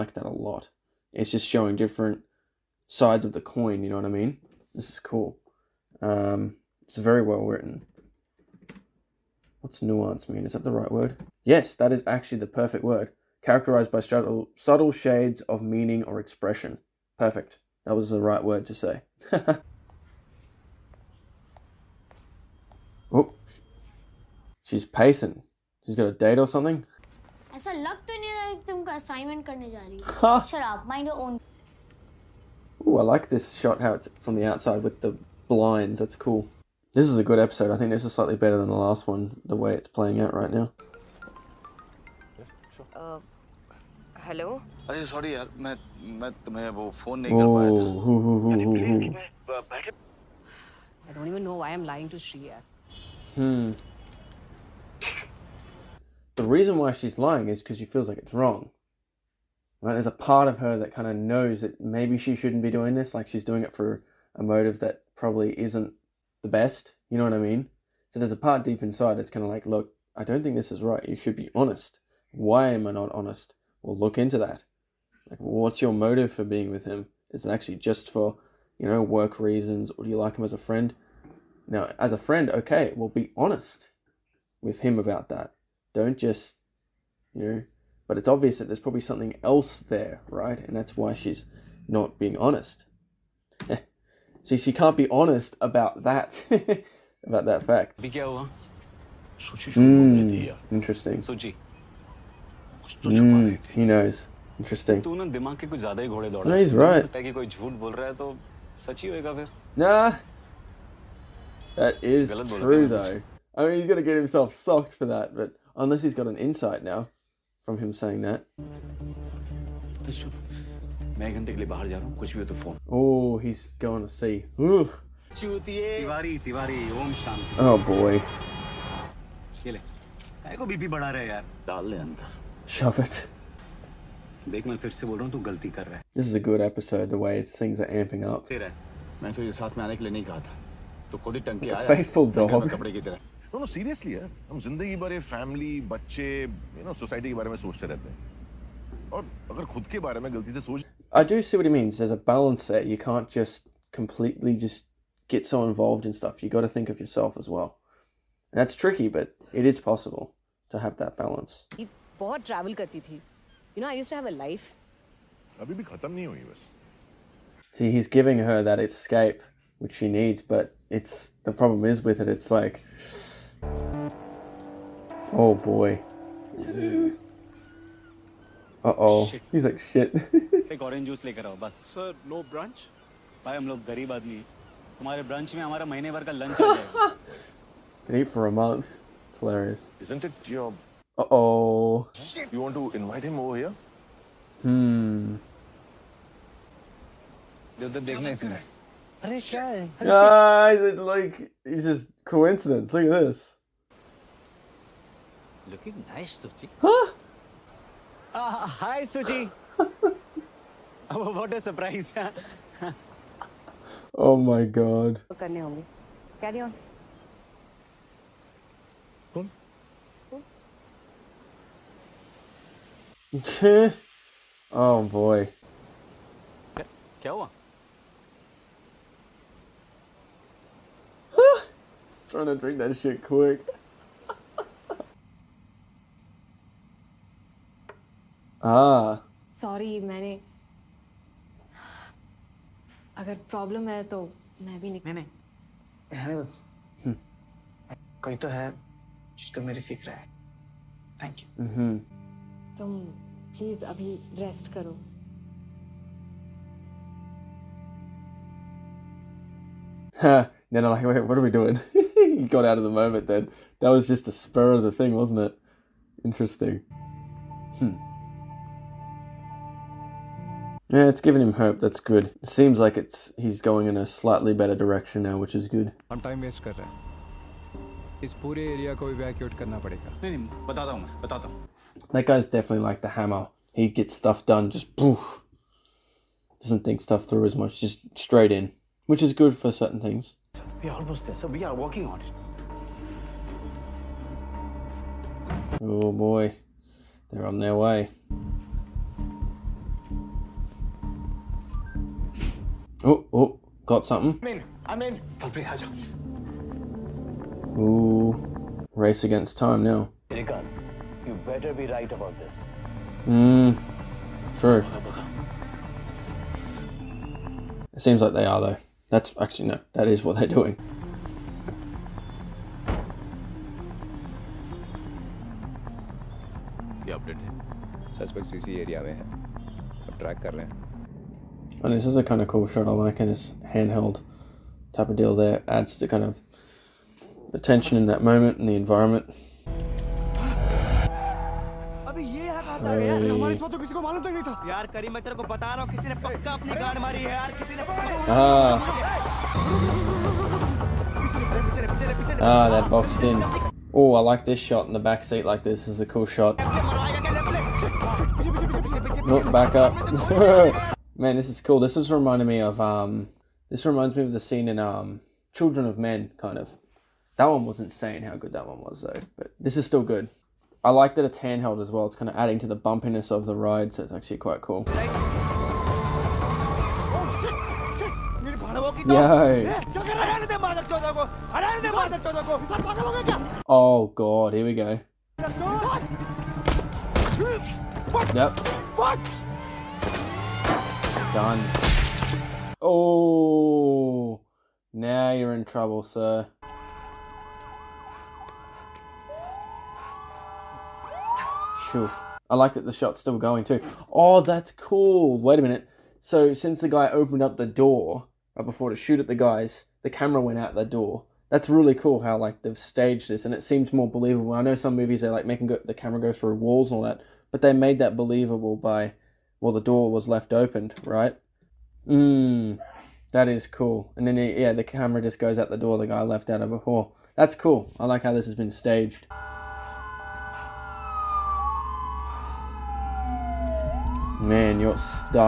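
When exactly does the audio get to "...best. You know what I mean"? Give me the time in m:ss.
1:06.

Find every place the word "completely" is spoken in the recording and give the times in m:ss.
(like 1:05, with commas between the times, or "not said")
2:33.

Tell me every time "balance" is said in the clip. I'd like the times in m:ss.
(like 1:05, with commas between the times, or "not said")
2:32, 2:41.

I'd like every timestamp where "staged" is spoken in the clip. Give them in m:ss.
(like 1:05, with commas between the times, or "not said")
6:52, 7:08.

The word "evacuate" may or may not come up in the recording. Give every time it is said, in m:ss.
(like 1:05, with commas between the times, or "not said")
4:39.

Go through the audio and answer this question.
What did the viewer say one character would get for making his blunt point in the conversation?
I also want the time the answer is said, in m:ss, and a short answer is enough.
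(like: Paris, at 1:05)
Socked, at 1:54.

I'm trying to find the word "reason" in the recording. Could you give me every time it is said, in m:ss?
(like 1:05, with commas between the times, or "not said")
0:56, 1:19.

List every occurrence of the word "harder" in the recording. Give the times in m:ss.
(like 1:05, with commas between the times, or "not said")
not said.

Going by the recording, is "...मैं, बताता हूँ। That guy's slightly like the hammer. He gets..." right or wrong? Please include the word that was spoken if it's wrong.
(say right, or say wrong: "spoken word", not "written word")
wrong: "definitely", not "slightly".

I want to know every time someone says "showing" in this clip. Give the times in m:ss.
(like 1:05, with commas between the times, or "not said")
0:01.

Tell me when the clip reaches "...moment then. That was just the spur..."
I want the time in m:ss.
4:22.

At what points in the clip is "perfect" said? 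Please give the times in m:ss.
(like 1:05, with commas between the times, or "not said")
0:12, 0:17.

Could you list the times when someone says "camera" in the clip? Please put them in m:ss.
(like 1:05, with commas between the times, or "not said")
6:50, 6:55, 7:04.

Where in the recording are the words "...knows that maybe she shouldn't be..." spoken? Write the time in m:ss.
1:01.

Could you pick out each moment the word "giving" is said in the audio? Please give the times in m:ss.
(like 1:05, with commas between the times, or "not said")
2:48, 4:31.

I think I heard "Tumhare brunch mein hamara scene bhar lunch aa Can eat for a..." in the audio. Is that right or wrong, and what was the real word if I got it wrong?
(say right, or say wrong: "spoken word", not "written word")
wrong: "mahine", not "scene".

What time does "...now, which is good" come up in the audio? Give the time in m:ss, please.
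4:35.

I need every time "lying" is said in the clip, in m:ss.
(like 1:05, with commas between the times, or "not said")
0:51, 0:57.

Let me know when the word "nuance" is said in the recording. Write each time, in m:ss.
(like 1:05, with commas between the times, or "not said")
0:09.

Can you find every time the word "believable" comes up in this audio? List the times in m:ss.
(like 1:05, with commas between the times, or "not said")
6:54, 6:58.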